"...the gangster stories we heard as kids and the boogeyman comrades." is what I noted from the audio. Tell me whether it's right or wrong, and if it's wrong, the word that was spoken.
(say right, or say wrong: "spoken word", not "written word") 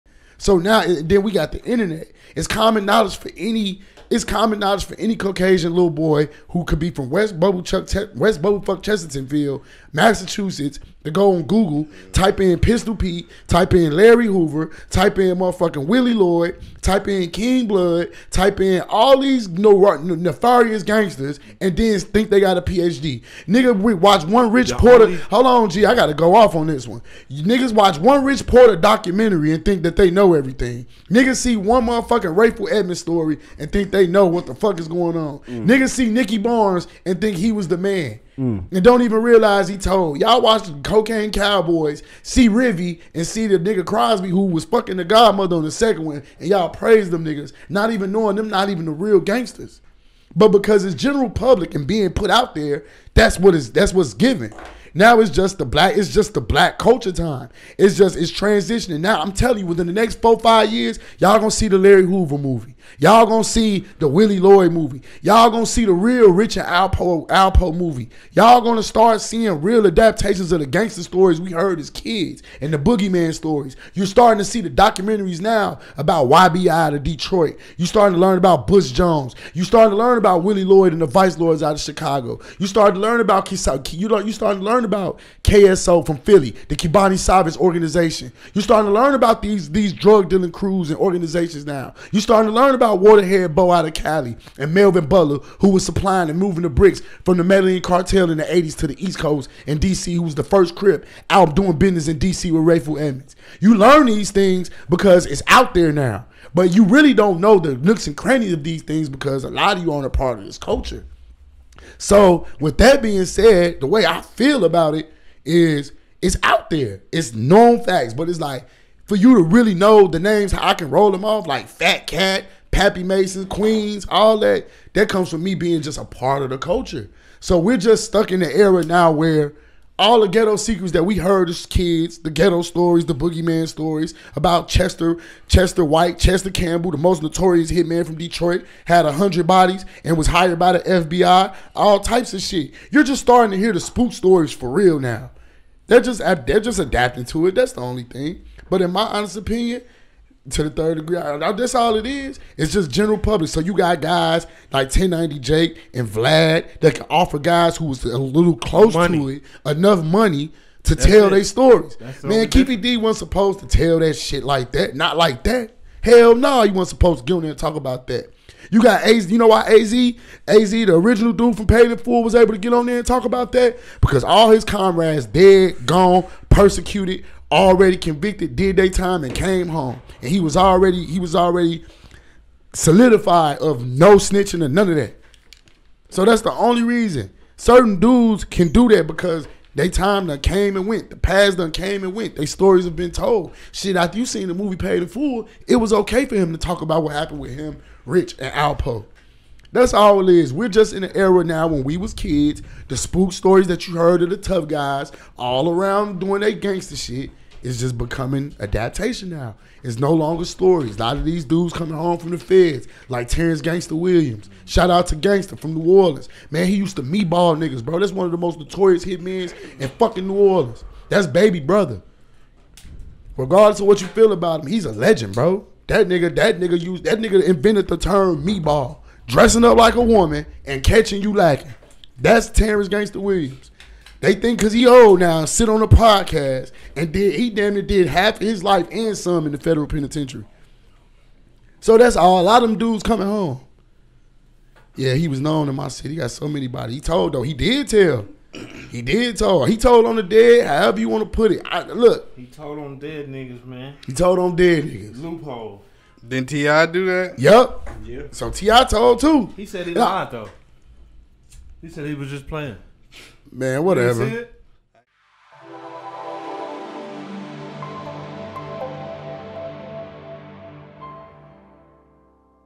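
wrong: "stories", not "comrades".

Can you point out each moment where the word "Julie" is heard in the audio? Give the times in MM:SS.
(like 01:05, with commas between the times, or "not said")
not said.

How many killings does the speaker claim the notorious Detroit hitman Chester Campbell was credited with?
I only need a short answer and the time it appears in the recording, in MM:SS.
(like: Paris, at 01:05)
100, at 02:19.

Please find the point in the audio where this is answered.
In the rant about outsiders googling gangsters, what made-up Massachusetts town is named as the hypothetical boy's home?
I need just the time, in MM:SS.
00:08.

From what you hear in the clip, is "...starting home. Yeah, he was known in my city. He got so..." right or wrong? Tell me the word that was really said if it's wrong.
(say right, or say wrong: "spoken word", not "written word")
wrong: "coming", not "starting".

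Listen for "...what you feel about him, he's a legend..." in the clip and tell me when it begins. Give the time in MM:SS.
03:43.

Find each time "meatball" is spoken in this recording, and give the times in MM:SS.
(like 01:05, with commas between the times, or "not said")
03:37, 03:48.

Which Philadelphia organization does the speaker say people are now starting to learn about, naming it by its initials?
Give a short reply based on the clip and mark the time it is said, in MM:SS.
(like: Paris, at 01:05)
KSO, at 01:25.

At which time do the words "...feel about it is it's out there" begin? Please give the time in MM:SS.
01:54.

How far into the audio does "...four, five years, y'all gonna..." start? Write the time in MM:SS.
01:00.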